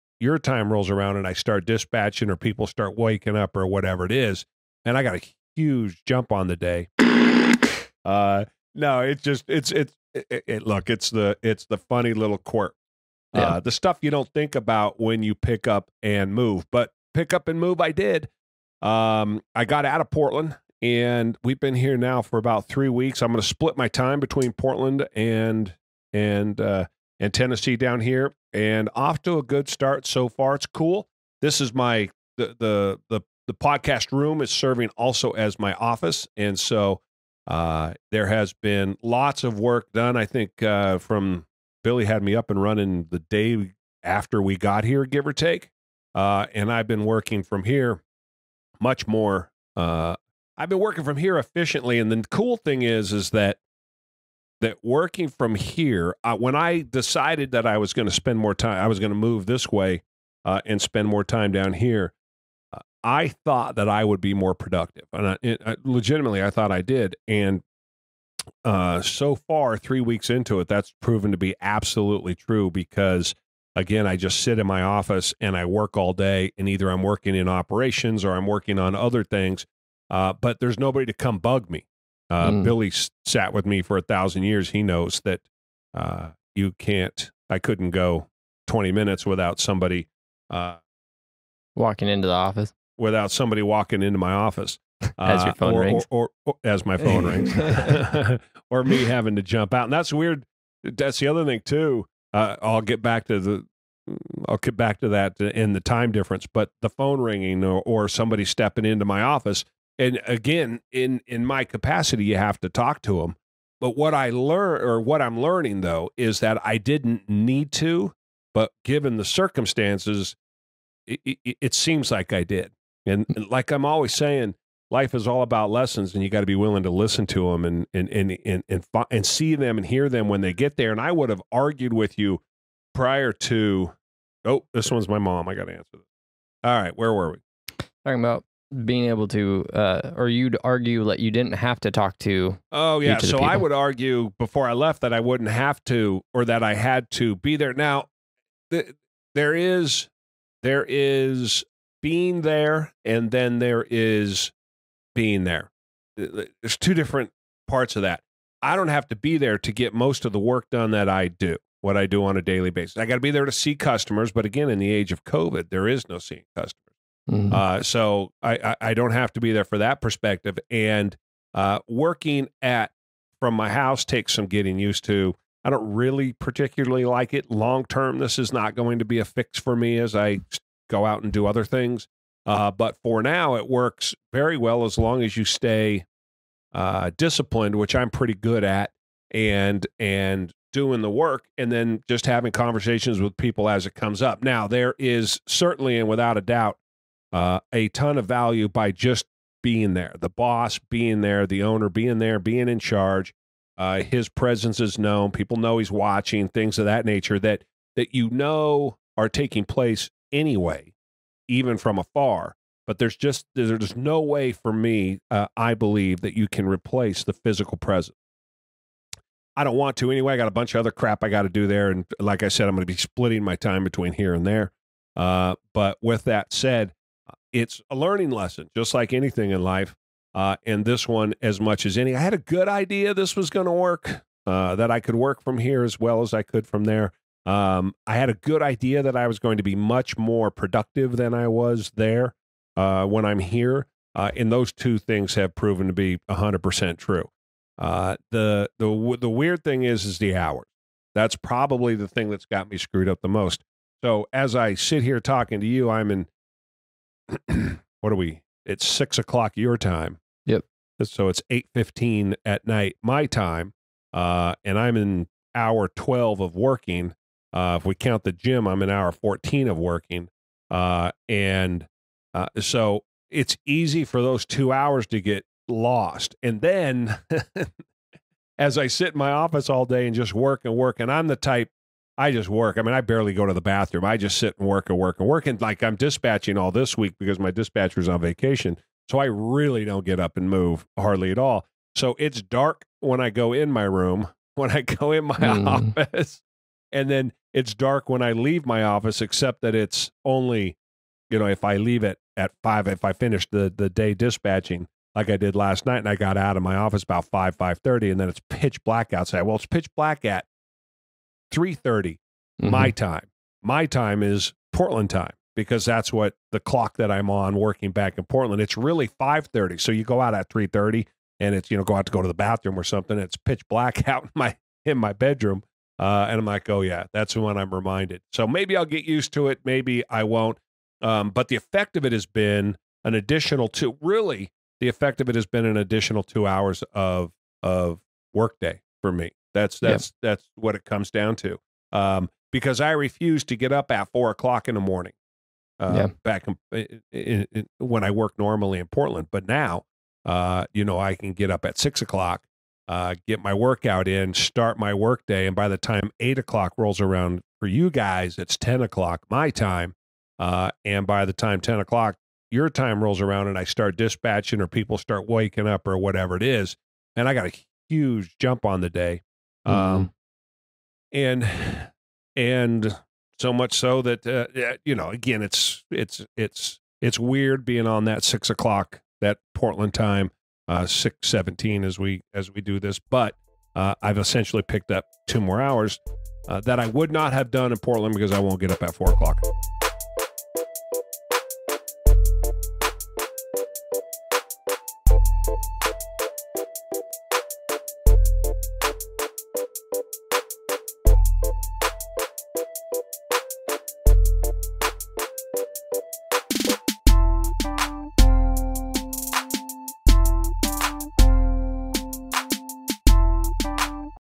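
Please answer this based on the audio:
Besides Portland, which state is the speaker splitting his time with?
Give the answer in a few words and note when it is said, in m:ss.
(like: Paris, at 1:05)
Tennessee, at 0:27.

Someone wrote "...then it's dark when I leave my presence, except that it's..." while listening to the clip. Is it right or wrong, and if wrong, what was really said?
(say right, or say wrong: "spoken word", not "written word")
wrong: "office", not "presence".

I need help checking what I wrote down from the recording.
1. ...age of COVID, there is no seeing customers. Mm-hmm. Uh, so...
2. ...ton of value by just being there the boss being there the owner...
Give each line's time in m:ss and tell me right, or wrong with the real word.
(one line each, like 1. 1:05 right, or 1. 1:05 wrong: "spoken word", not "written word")
1. 2:44 right
2. 3:17 right.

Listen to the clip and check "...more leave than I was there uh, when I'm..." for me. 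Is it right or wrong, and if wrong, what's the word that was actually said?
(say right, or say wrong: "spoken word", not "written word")
wrong: "productive", not "leave".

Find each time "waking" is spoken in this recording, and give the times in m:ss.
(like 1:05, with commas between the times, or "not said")
0:02, 6:05.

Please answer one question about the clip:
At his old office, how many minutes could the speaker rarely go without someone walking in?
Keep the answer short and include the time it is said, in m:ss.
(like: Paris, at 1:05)
20, at 1:28.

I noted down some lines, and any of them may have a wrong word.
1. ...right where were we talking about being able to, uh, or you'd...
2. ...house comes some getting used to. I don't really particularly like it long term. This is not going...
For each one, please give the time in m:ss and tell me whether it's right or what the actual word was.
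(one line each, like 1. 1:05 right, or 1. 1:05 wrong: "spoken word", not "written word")
1. 2:16 right
2. 2:53 wrong: "takes", not "comes".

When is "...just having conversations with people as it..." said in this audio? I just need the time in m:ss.
3:12.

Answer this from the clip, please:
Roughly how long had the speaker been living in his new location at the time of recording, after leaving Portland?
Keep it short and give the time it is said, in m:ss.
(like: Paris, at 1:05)
3 weeks, at 0:22.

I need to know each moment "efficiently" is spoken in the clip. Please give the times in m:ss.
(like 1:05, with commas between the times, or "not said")
0:51.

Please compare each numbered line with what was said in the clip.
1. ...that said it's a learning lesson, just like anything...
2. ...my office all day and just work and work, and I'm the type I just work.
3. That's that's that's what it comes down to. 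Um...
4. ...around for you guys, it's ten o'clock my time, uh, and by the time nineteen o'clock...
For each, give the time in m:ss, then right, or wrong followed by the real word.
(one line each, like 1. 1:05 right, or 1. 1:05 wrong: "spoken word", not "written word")
1. 3:46 right
2. 4:39 right
3. 5:39 right
4. 5:57 wrong: "ten", not "nineteen".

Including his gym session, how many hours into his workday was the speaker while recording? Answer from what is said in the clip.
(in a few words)
14.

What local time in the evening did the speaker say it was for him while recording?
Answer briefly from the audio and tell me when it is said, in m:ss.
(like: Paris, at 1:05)
8:15, at 4:21.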